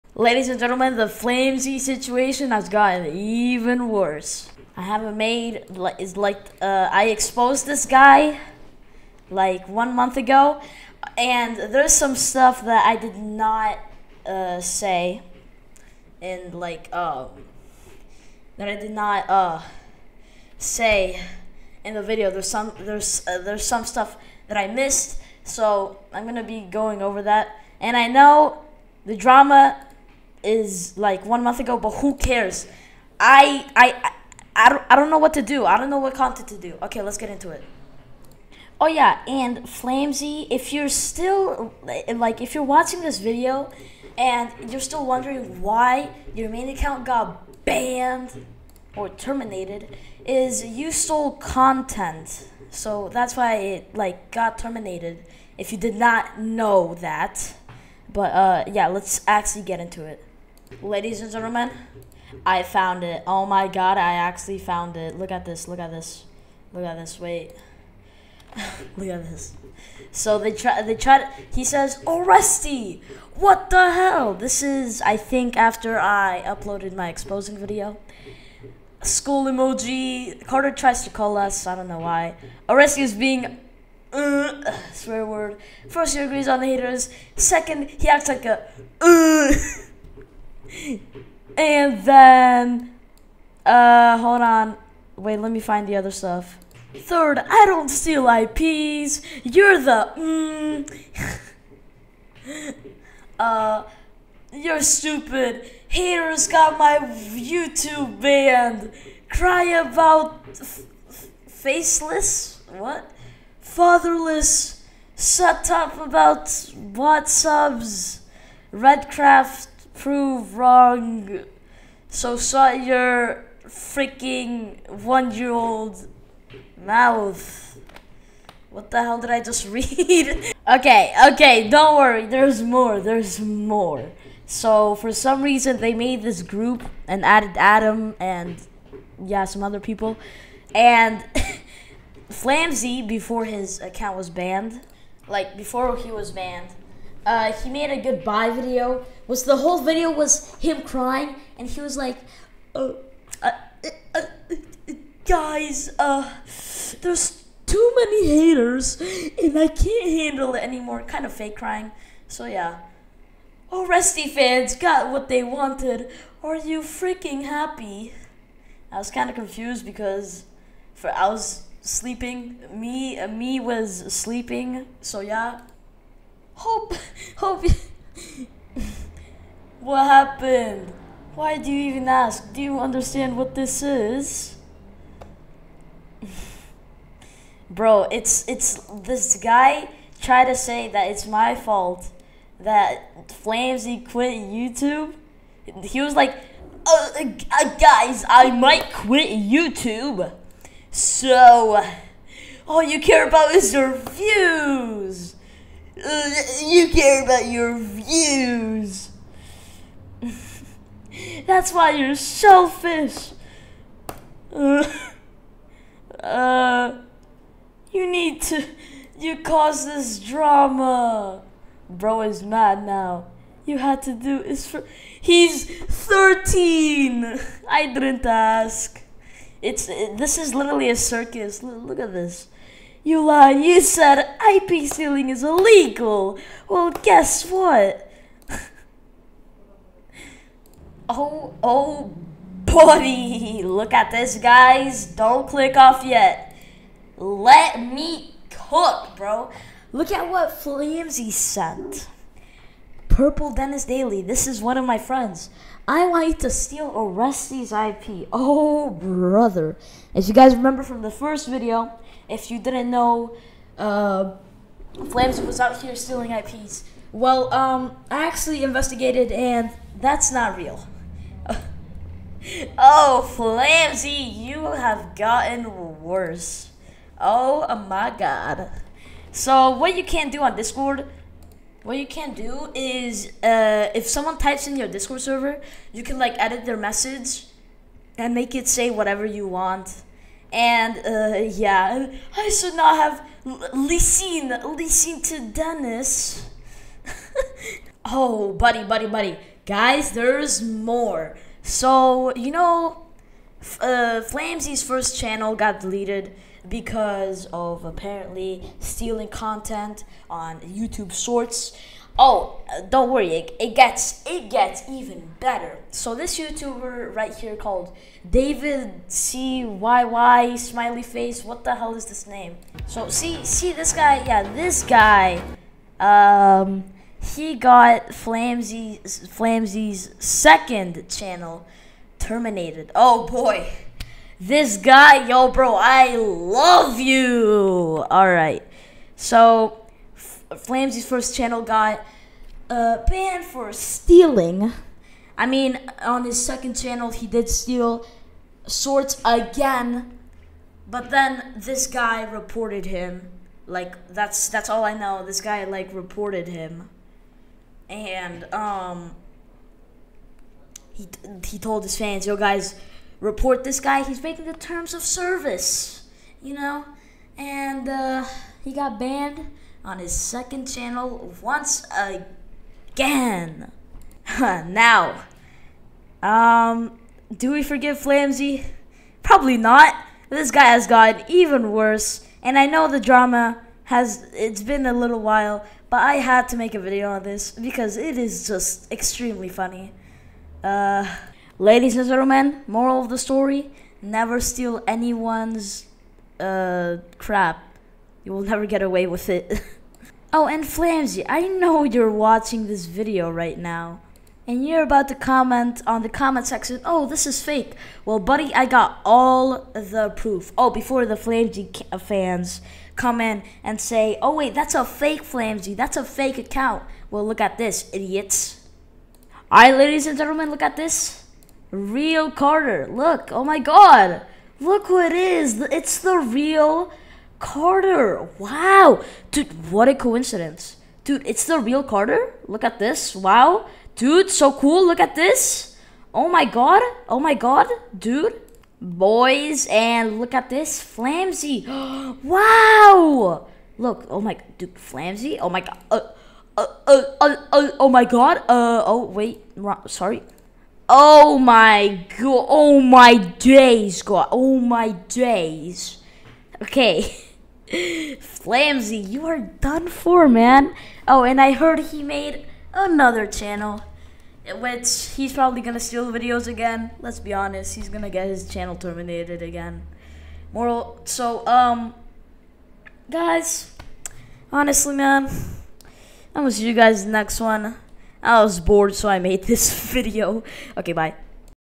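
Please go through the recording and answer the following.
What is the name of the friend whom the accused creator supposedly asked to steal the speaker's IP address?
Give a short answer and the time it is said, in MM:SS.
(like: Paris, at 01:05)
Purple Dennis Daily, at 04:13.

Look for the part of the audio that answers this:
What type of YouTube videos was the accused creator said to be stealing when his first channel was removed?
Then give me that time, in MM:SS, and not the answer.
05:10.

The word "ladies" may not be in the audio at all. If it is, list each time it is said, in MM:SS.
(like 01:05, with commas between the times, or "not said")
00:00, 01:00, 06:31, 06:59.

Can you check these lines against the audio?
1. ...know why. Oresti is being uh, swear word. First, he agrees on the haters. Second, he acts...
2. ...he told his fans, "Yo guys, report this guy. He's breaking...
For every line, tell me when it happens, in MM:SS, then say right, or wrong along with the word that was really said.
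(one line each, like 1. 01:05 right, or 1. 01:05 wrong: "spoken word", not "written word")
1. 01:21 right
2. 06:01 right.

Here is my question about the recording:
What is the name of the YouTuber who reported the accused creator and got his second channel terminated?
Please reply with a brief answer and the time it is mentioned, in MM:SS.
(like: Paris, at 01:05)
David C Y Y, at 05:18.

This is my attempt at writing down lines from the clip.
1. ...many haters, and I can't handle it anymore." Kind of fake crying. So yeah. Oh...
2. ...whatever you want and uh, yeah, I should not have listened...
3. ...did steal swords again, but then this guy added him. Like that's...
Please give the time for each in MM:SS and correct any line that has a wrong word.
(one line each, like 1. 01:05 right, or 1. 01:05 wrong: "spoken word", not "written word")
1. 02:37 right
2. 04:48 right
3. 05:47 wrong: "reported", not "added".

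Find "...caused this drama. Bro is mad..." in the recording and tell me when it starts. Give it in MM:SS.
03:39.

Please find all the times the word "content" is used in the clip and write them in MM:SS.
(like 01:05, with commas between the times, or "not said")
00:36, 00:51, 05:09.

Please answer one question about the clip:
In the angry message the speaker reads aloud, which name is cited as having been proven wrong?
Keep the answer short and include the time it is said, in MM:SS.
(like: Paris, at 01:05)
Redcraft, at 01:58.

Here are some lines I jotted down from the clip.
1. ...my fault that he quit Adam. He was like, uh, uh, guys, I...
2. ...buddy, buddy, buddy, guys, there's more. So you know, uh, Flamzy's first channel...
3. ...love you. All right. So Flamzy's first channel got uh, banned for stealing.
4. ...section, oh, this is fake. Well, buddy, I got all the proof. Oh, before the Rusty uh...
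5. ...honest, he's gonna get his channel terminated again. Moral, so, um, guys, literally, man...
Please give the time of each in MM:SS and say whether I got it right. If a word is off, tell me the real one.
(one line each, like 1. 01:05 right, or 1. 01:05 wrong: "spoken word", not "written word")
1. 03:11 wrong: "YouTube", not "Adam"
2. 04:58 right
3. 05:36 right
4. 06:46 wrong: "Flamzy", not "Rusty"
5. 07:47 wrong: "honestly", not "literally".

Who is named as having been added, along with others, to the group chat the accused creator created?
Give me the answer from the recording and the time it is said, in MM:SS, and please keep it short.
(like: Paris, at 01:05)
Adam, at 02:17.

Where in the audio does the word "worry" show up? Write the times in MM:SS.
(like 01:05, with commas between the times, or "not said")
02:11, 05:13.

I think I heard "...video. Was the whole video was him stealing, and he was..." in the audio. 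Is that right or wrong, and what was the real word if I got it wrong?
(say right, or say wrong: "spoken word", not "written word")
wrong: "crying", not "stealing".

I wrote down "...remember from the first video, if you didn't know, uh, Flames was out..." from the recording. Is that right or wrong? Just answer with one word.
right.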